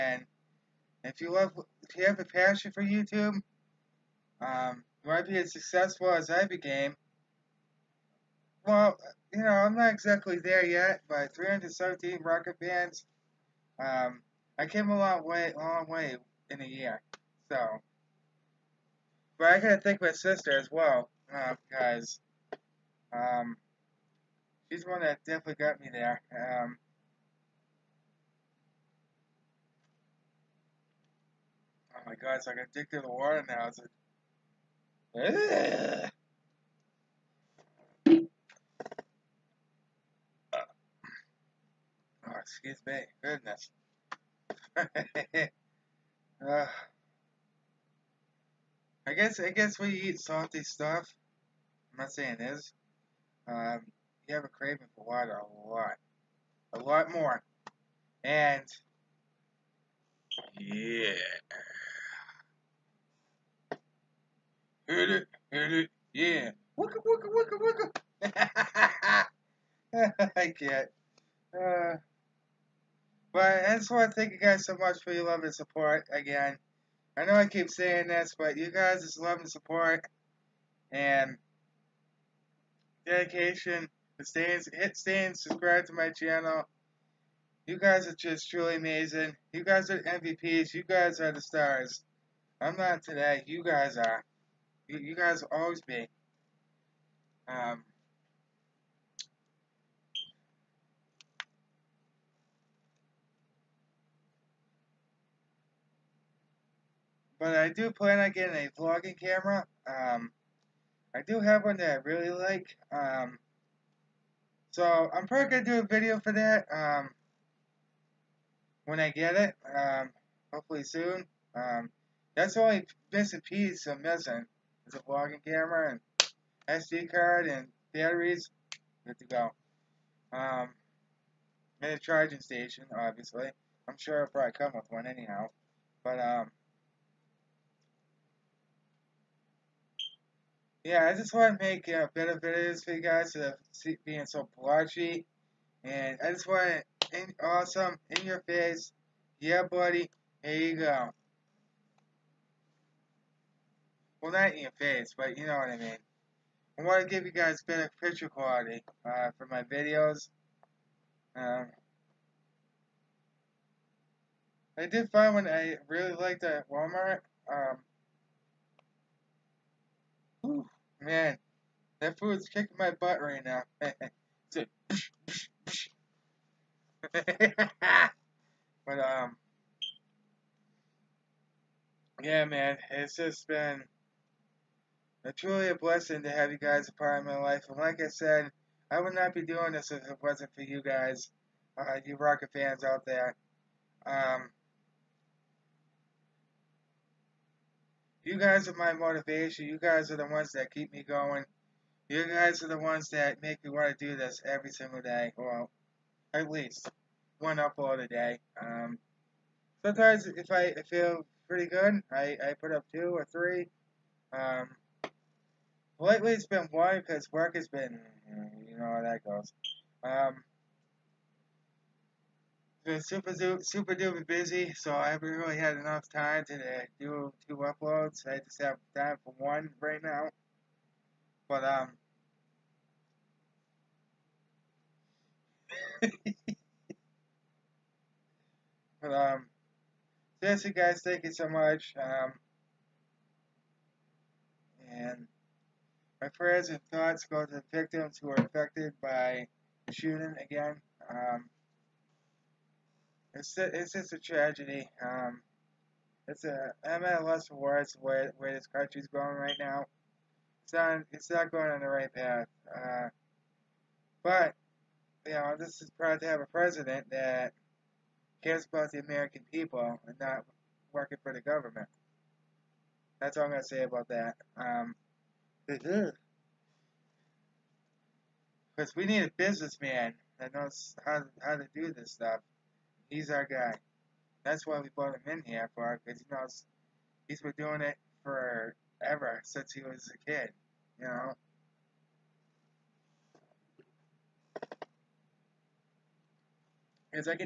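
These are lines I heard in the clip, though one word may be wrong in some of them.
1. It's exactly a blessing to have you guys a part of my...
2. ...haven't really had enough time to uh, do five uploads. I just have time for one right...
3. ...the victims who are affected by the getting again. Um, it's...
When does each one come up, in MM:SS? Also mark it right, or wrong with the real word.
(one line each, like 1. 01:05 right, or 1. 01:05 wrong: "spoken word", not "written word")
1. 03:05 wrong: "truly", not "exactly"
2. 03:45 wrong: "two", not "five"
3. 04:07 wrong: "shooting", not "getting".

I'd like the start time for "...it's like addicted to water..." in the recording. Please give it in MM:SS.
00:32.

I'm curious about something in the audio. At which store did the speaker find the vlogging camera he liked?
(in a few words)
Walmart.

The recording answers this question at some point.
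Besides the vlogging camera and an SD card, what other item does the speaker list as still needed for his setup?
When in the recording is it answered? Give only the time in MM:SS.
02:07.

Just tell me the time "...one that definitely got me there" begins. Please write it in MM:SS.
00:24.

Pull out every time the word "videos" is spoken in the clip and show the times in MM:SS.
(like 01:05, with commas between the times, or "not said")
01:55, 02:22, 02:39.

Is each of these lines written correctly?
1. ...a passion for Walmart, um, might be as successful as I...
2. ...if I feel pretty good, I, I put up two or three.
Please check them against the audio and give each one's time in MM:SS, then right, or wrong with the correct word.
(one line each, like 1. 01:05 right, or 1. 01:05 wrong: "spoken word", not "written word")
1. 00:02 wrong: "YouTube", not "Walmart"
2. 03:30 right.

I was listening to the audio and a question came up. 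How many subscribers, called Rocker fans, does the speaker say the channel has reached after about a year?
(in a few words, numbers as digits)
317.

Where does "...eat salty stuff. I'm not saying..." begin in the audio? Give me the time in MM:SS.
00:49.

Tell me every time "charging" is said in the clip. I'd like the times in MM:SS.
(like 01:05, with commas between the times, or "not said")
02:11.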